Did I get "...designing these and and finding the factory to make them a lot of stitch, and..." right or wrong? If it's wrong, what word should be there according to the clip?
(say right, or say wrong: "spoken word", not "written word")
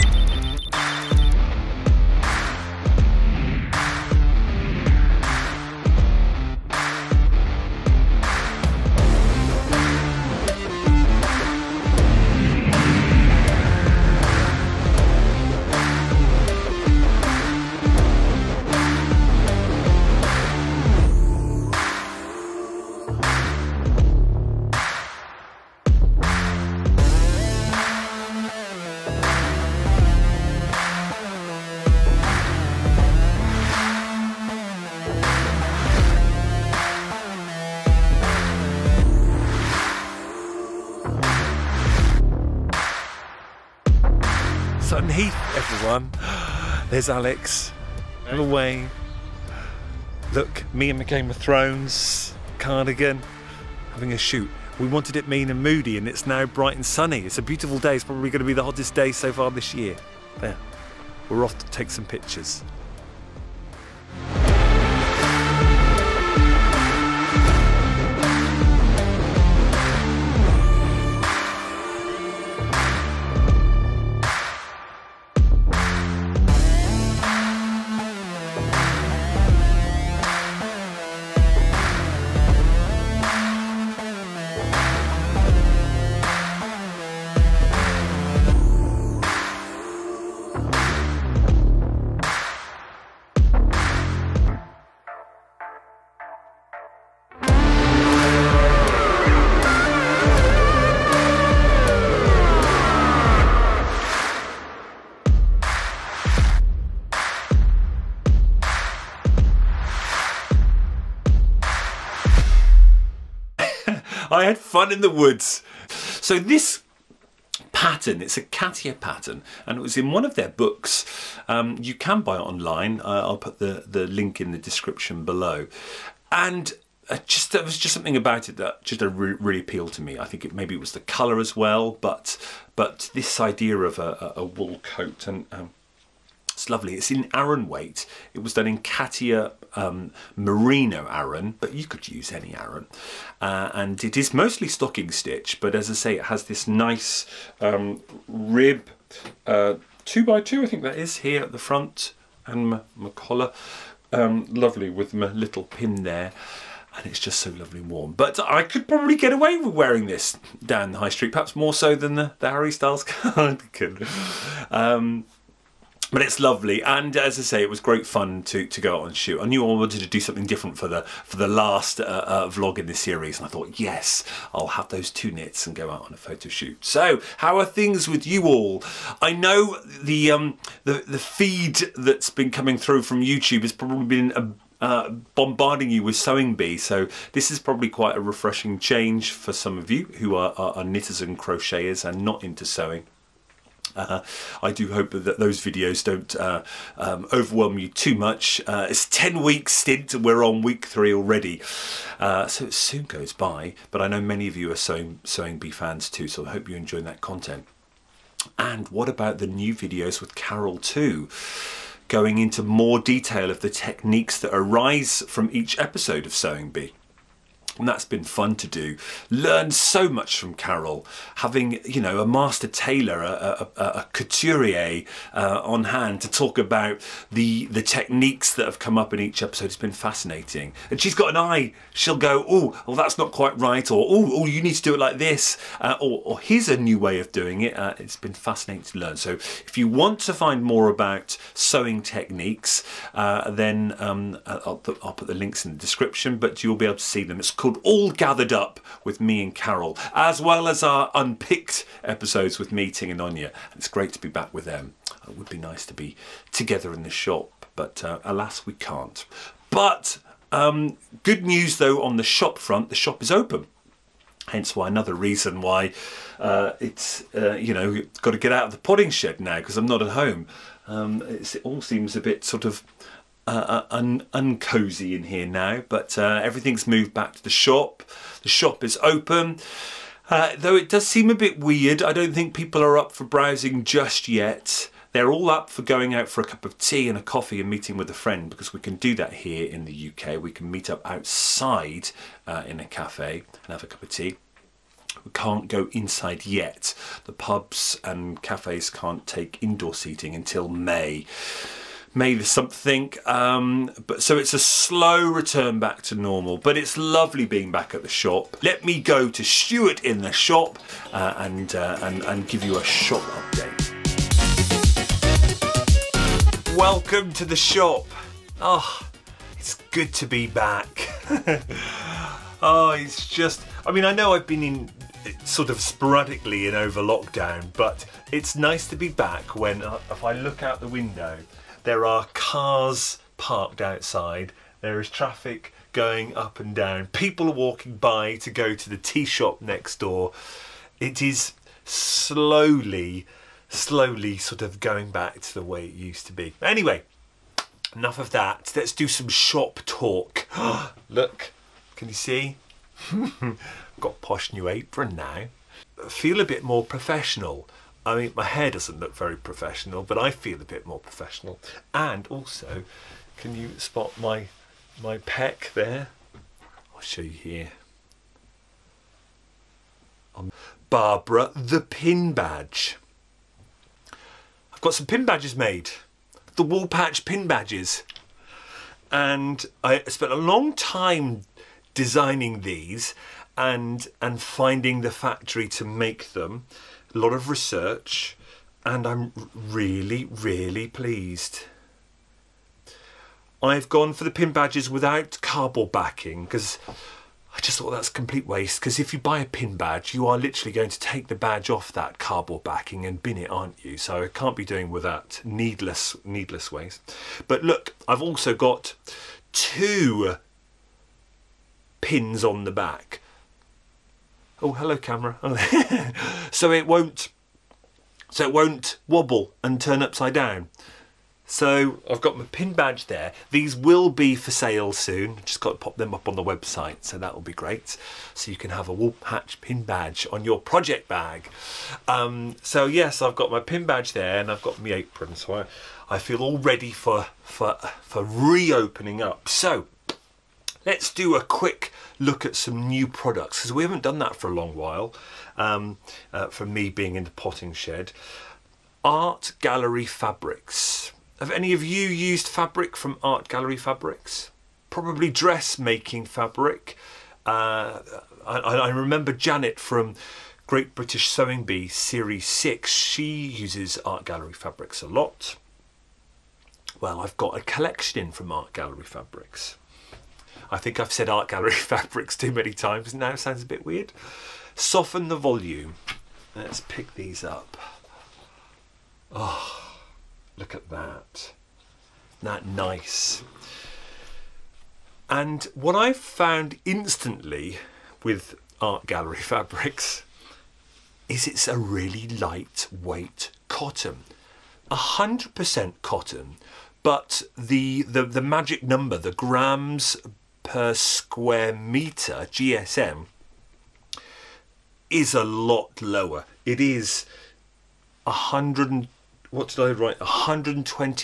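wrong: "research", not "stitch".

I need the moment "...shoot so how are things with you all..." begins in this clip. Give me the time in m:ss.
2:56.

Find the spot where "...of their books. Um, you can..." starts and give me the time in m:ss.
2:00.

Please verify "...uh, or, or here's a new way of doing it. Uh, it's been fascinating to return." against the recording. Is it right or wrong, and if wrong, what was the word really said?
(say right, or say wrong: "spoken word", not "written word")
wrong: "learn", not "return".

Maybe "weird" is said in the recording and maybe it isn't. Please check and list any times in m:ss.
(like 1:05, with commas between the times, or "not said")
4:41, 7:53.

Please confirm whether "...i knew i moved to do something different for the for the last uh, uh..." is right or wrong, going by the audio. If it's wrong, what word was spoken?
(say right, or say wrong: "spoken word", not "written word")
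wrong: "wanted", not "moved".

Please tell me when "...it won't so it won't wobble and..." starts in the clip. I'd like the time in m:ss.
6:56.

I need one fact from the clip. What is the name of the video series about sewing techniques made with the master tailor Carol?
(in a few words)
All Gathered Up.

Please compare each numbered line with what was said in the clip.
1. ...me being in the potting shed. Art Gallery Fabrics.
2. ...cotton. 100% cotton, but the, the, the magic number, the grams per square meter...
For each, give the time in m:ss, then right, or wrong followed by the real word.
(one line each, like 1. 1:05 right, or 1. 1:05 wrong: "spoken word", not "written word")
1. 7:26 right
2. 8:13 right.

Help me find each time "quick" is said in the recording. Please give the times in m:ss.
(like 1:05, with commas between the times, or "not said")
7:21.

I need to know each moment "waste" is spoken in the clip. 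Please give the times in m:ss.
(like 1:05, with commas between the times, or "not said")
6:38, 6:46.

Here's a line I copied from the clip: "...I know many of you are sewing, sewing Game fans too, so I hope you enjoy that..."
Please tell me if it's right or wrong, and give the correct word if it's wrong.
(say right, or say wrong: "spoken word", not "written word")
wrong: "Bee", not "Game".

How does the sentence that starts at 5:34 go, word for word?
There is traffic going up and down.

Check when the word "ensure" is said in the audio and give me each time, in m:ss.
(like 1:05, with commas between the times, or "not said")
not said.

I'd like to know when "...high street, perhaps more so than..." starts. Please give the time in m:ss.
2:40.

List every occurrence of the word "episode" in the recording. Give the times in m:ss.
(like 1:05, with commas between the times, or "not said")
3:35, 3:49, 4:12.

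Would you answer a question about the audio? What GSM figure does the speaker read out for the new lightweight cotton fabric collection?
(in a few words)
125.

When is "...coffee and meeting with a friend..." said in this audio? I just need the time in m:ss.
4:47.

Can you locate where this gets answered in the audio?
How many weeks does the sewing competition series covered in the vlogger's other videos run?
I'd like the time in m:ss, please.
3:19.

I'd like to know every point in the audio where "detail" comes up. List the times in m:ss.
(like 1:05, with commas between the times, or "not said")
3:32.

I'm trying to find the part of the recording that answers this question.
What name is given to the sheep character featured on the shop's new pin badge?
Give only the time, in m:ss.
6:10.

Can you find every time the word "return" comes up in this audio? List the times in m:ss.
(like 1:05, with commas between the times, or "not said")
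5:05.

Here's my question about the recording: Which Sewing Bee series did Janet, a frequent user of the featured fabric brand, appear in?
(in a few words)
Series 6.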